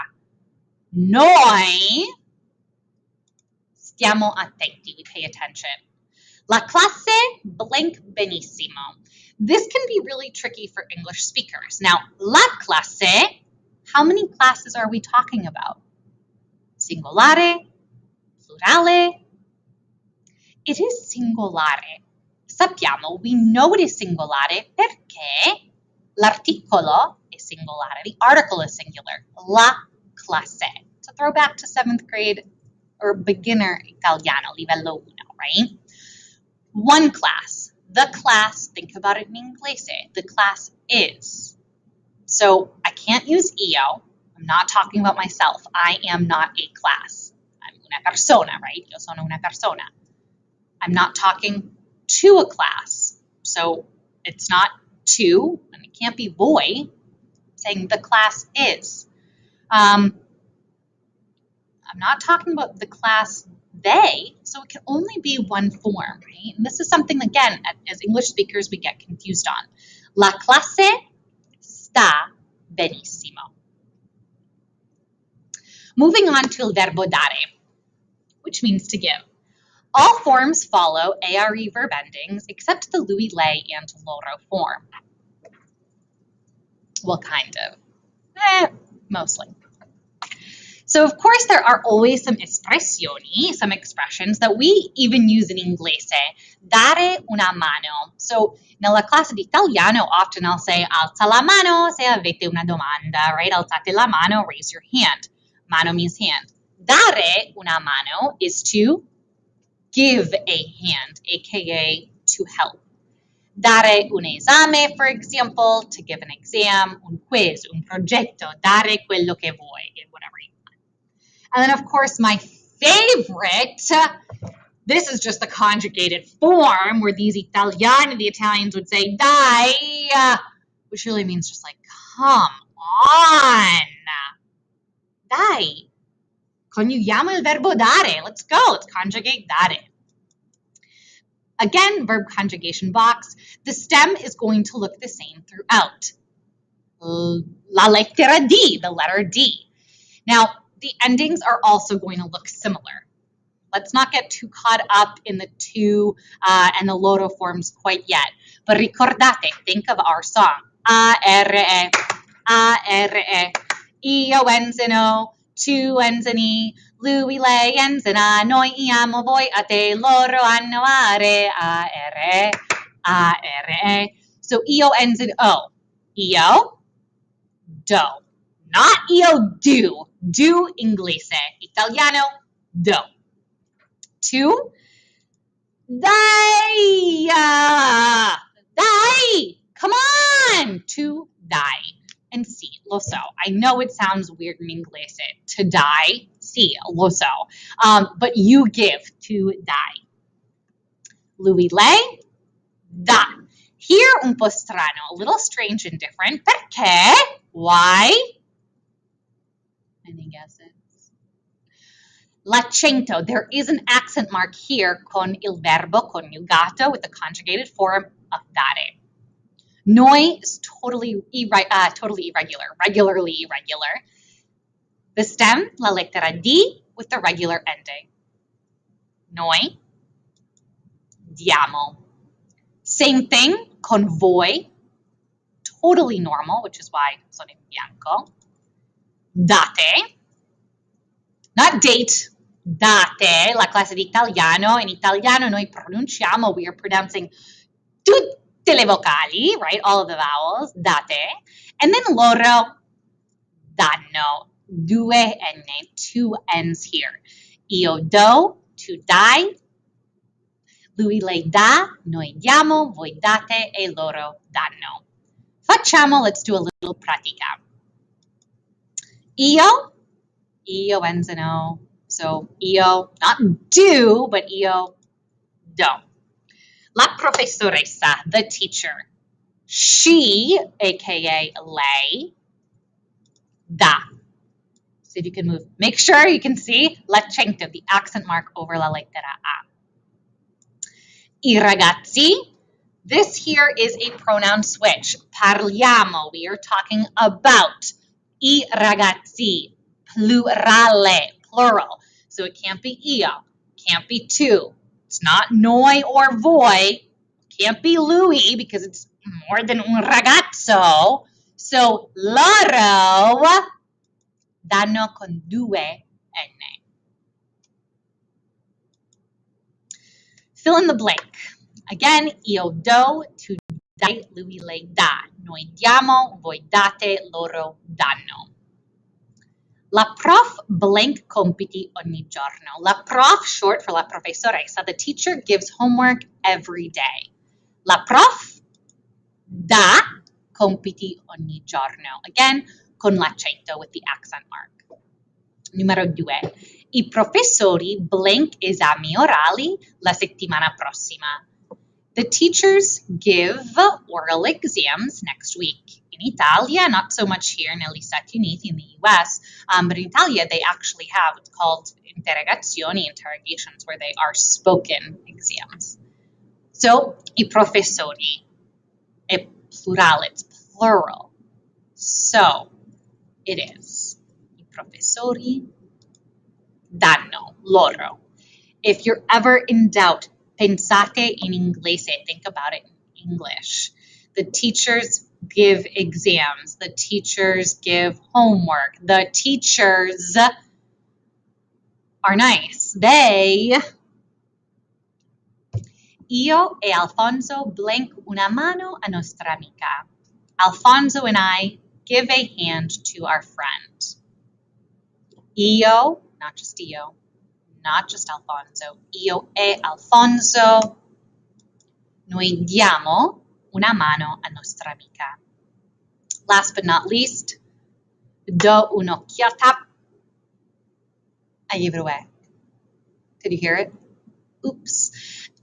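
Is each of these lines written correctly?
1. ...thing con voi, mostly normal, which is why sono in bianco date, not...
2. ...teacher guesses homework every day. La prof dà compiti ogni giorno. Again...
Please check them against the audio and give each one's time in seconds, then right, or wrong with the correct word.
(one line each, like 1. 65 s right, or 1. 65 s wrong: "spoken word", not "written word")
1. 233 s wrong: "totally", not "mostly"
2. 334 s wrong: "gives", not "guesses".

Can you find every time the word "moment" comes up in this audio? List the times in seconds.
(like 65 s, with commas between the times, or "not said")
not said.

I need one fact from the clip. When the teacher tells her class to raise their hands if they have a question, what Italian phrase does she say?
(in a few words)
alza la mano.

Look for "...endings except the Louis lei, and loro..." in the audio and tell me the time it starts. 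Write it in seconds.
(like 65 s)
81 s.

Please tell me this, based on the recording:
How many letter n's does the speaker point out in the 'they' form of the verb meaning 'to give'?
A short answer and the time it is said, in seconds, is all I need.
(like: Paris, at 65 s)
2, at 254 s.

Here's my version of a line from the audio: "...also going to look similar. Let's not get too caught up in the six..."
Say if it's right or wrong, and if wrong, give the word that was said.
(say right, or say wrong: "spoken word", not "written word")
wrong: "two", not "six".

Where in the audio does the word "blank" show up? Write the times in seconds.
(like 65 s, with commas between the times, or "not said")
7 s, 320 s, 330 s, 348 s, 397 s.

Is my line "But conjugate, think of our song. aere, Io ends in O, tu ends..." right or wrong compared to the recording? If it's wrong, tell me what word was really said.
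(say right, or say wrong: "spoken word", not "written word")
wrong: "ricordate", not "conjugate".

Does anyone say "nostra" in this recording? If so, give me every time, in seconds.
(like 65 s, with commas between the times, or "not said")
399 s, 414 s.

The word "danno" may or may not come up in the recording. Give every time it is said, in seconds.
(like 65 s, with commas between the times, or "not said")
253 s, 264 s, 314 s, 327 s, 376 s.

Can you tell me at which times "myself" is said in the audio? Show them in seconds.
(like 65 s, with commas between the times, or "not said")
45 s.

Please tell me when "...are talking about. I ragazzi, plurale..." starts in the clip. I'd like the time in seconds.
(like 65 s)
296 s.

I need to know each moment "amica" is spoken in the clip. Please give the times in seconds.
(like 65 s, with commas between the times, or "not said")
399 s, 414 s.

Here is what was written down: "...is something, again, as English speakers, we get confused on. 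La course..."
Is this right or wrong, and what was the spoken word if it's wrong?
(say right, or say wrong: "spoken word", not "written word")
wrong: "clase", not "course".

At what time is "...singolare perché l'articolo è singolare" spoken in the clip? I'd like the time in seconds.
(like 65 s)
23 s.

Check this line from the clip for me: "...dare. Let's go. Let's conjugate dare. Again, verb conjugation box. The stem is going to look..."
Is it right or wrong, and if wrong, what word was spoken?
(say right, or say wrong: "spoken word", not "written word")
right.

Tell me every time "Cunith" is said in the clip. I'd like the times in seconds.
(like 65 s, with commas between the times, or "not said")
358 s.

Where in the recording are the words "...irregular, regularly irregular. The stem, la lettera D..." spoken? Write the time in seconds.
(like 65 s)
222 s.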